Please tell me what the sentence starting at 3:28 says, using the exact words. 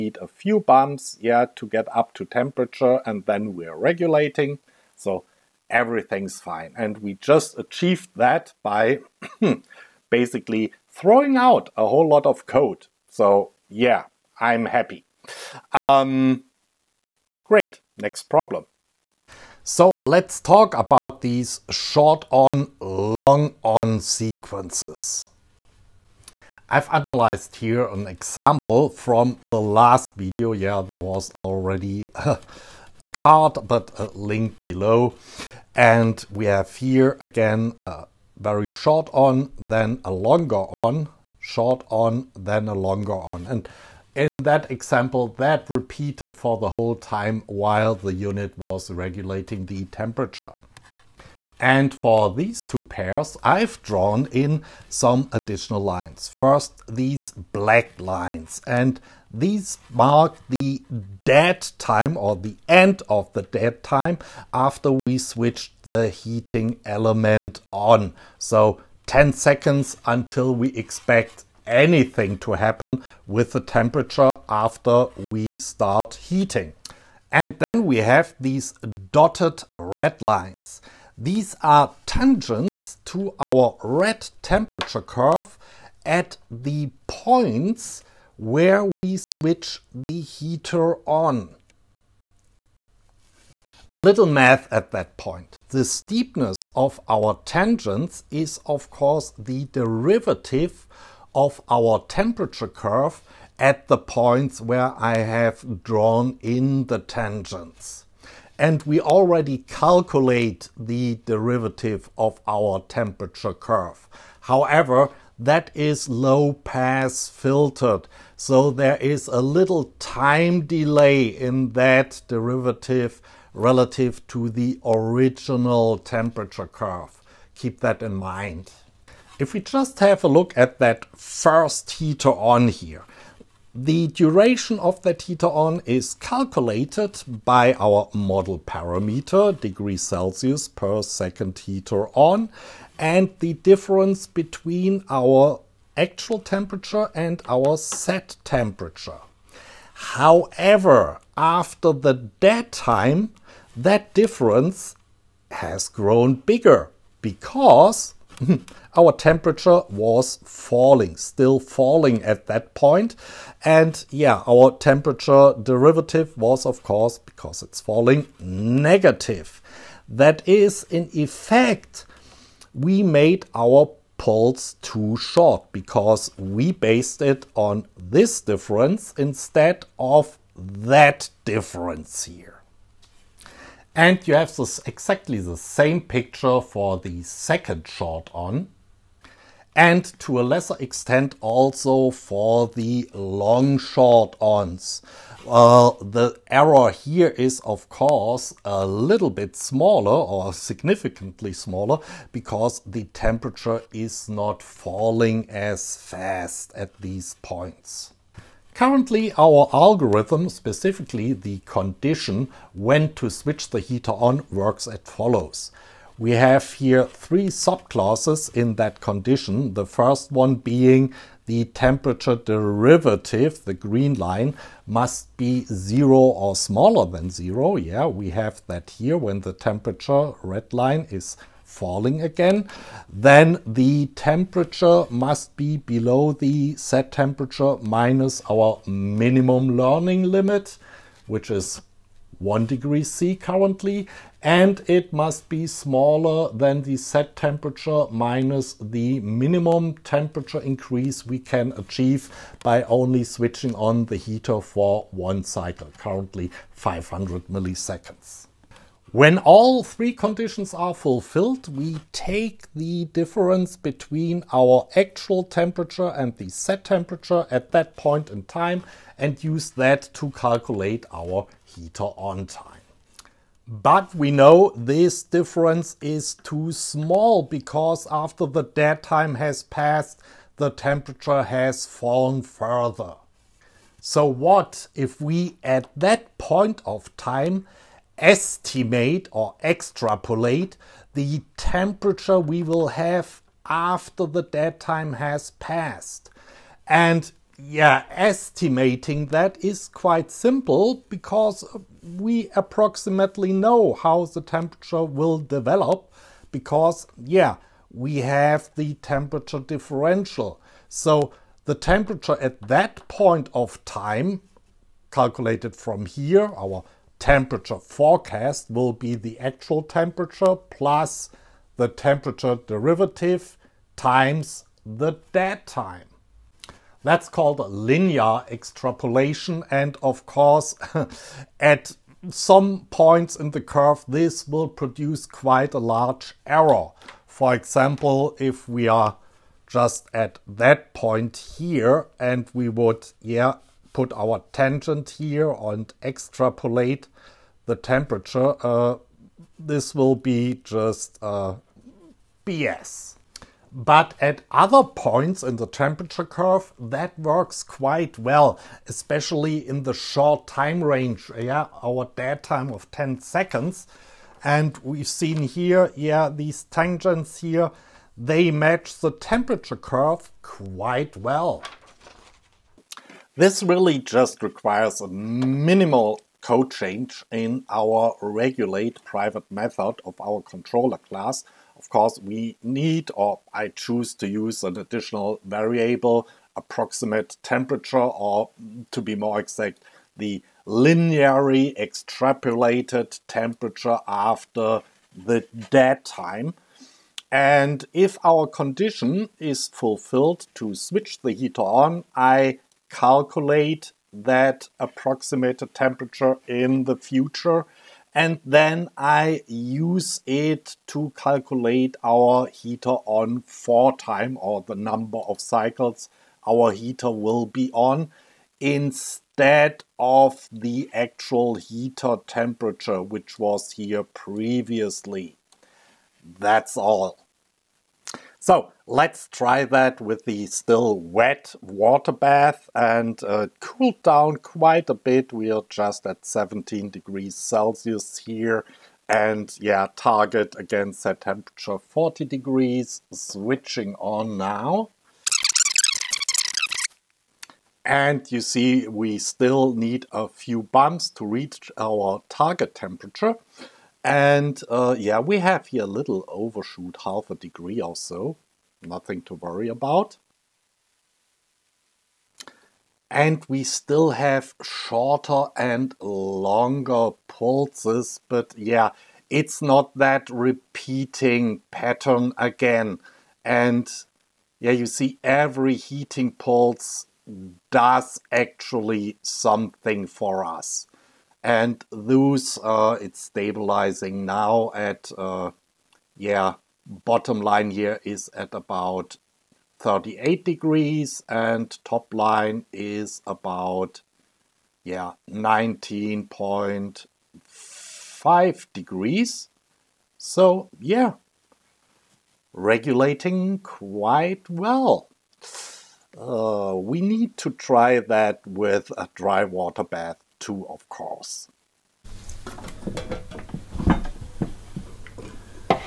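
Currently, our algorithm, specifically the condition when to switch the heater on, works as follows.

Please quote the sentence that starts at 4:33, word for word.
But we know this difference is too small because after the dead time has passed, the temperature has fallen further.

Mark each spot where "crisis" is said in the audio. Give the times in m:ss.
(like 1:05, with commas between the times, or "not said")
not said.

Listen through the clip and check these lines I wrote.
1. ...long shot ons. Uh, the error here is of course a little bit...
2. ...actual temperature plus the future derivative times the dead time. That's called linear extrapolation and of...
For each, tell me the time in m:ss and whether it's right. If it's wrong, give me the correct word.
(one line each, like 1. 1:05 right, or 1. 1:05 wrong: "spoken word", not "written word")
1. 3:13 right
2. 5:19 wrong: "temperature", not "future".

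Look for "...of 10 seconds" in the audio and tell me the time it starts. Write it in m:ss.
6:02.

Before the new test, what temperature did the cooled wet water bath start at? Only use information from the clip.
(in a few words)
17 degrees Celsius.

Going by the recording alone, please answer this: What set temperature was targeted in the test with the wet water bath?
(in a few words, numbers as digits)
40 degrees.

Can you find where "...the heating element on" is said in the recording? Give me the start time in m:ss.
1:05.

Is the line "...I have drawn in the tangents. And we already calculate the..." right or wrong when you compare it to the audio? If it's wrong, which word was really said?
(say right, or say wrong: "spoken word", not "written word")
right.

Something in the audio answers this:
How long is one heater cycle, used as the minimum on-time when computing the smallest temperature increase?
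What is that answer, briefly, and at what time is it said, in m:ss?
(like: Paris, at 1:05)
500 milliseconds, at 4:16.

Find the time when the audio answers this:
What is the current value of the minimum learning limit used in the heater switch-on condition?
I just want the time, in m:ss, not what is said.
4:02.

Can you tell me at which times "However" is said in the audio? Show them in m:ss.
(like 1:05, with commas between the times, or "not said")
1:54, 2:30.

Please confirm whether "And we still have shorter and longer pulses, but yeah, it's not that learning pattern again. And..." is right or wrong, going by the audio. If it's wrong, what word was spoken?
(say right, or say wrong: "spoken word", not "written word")
wrong: "repeating", not "learning".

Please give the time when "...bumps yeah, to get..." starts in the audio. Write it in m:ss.
0:00.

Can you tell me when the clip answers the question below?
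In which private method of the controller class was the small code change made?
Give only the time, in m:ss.
6:18.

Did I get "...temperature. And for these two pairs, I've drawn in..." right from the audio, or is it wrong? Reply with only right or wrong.
right.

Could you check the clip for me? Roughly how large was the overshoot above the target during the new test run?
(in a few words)
half a degree.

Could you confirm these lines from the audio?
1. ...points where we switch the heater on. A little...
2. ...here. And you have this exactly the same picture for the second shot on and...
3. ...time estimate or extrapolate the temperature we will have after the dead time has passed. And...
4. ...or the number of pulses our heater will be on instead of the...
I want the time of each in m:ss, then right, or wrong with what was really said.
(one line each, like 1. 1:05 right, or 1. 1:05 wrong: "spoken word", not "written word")
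1. 1:27 right
2. 3:02 right
3. 4:47 right
4. 6:54 wrong: "cycles", not "pulses".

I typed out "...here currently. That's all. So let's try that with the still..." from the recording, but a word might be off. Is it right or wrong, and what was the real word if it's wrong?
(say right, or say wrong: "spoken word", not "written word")
wrong: "previously", not "currently".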